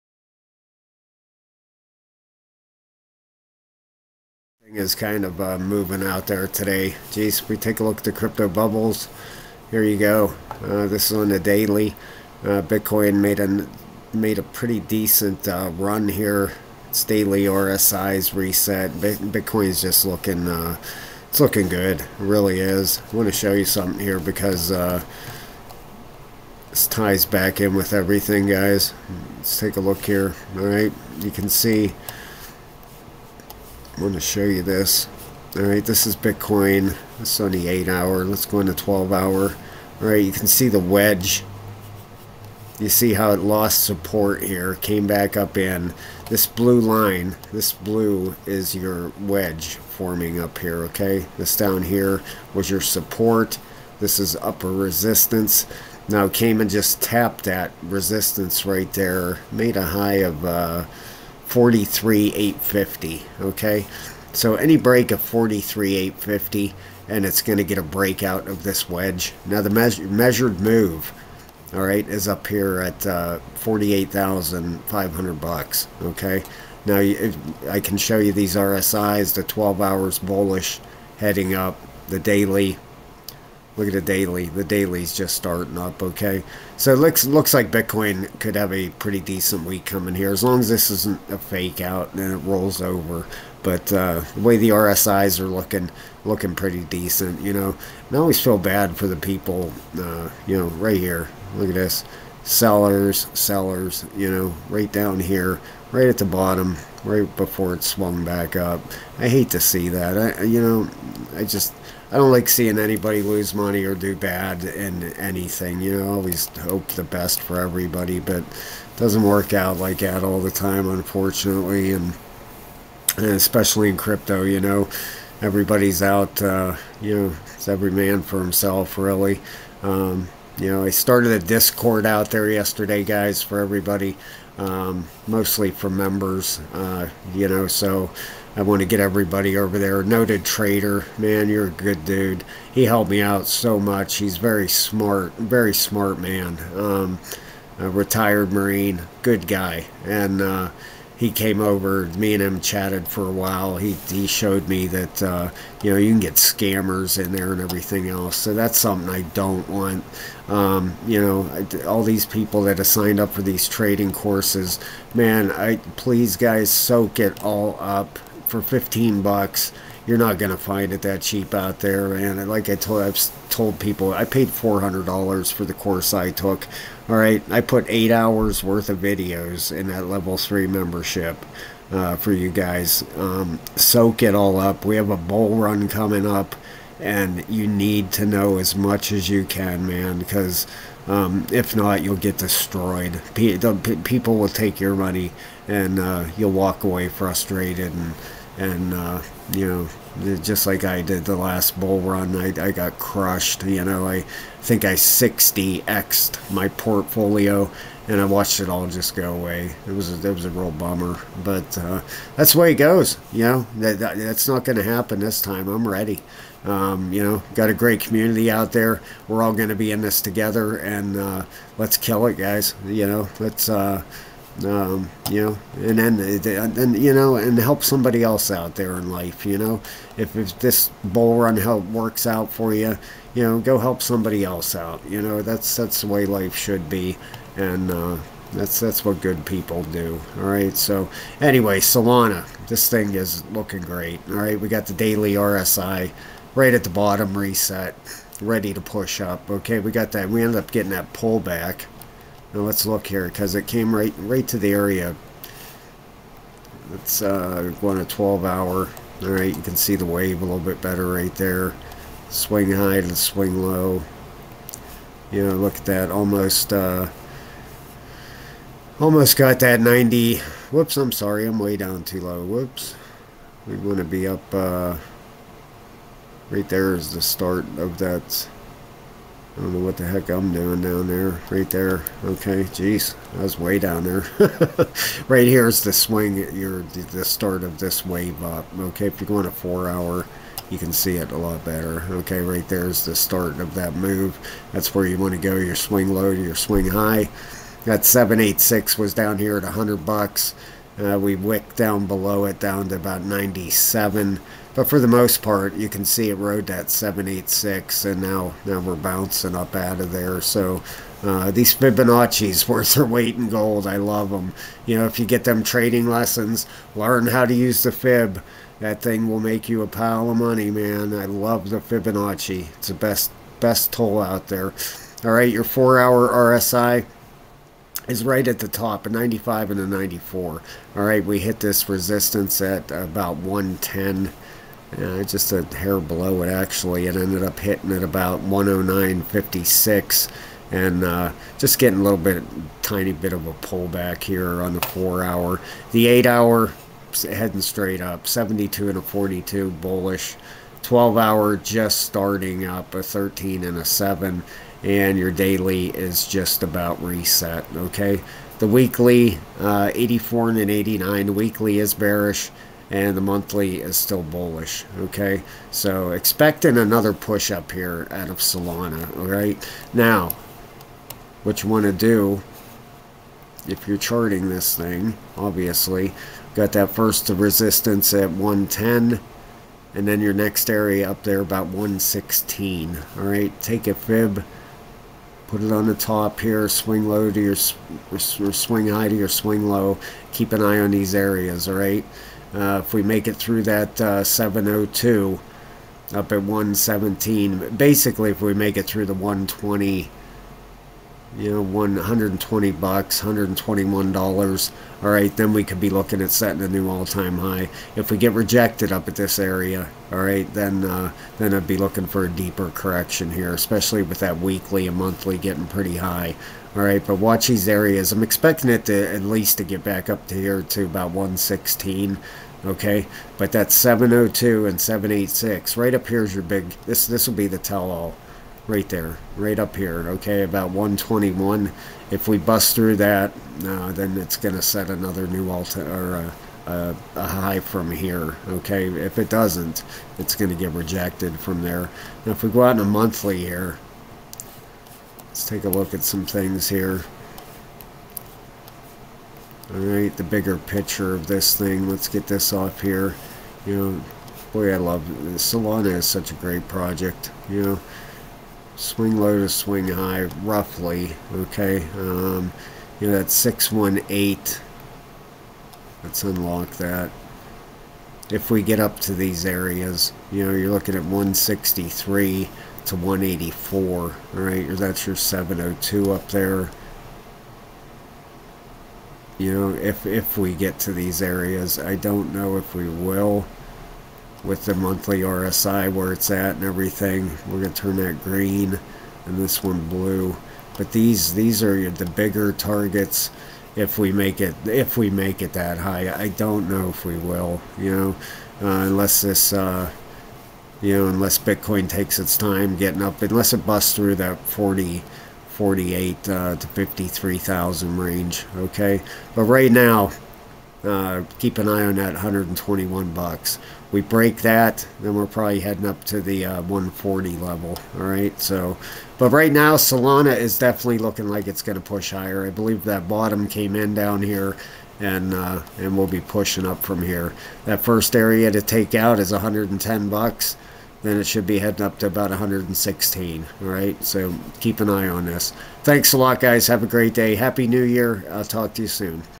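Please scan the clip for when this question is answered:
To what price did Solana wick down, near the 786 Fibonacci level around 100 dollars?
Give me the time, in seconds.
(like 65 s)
302 s.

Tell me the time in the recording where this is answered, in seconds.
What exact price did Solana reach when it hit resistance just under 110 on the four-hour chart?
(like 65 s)
338 s.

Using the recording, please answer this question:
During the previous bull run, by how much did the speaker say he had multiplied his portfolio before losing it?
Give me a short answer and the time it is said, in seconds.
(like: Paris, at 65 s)
60x, at 204 s.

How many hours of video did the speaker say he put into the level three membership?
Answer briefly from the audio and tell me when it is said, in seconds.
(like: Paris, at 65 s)
8 hours, at 177 s.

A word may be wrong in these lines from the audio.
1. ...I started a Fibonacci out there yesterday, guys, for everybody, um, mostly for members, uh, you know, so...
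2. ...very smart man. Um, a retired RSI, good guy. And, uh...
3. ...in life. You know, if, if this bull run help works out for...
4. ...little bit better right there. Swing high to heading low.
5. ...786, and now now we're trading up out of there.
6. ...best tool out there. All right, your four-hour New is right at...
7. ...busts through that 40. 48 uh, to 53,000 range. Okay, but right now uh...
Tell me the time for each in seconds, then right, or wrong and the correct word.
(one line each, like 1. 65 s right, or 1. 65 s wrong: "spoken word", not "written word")
1. 130 s wrong: "Discord", not "Fibonacci"
2. 145 s wrong: "Marine", not "RSI"
3. 228 s right
4. 260 s wrong: "swing", not "heading"
5. 306 s wrong: "bouncing", not "trading"
6. 323 s wrong: "RSI", not "New"
7. 503 s right.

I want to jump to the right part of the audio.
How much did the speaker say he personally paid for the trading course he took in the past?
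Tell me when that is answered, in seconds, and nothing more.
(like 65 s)
174 s.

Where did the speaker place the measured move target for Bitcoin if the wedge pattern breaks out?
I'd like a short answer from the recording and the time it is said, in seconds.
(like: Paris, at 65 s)
48,500, at 73 s.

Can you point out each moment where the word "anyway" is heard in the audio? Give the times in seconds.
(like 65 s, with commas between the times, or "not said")
241 s.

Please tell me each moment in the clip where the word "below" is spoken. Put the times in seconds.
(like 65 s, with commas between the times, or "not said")
302 s, 335 s.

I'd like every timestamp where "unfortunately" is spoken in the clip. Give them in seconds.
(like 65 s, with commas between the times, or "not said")
120 s.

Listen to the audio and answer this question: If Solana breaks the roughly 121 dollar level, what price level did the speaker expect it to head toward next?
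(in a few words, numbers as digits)
140.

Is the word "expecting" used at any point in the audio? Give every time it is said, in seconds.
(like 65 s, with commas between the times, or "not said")
366 s, 418 s.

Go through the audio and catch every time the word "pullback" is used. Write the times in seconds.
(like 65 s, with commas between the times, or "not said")
251 s, 343 s.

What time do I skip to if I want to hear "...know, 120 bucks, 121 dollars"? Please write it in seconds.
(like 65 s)
401 s.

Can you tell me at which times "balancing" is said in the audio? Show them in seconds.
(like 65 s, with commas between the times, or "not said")
not said.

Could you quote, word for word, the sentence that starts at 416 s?
All right, but watch these areas.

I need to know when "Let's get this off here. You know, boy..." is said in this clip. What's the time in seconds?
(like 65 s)
451 s.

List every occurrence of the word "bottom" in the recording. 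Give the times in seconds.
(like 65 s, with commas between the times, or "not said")
106 s, 246 s, 523 s.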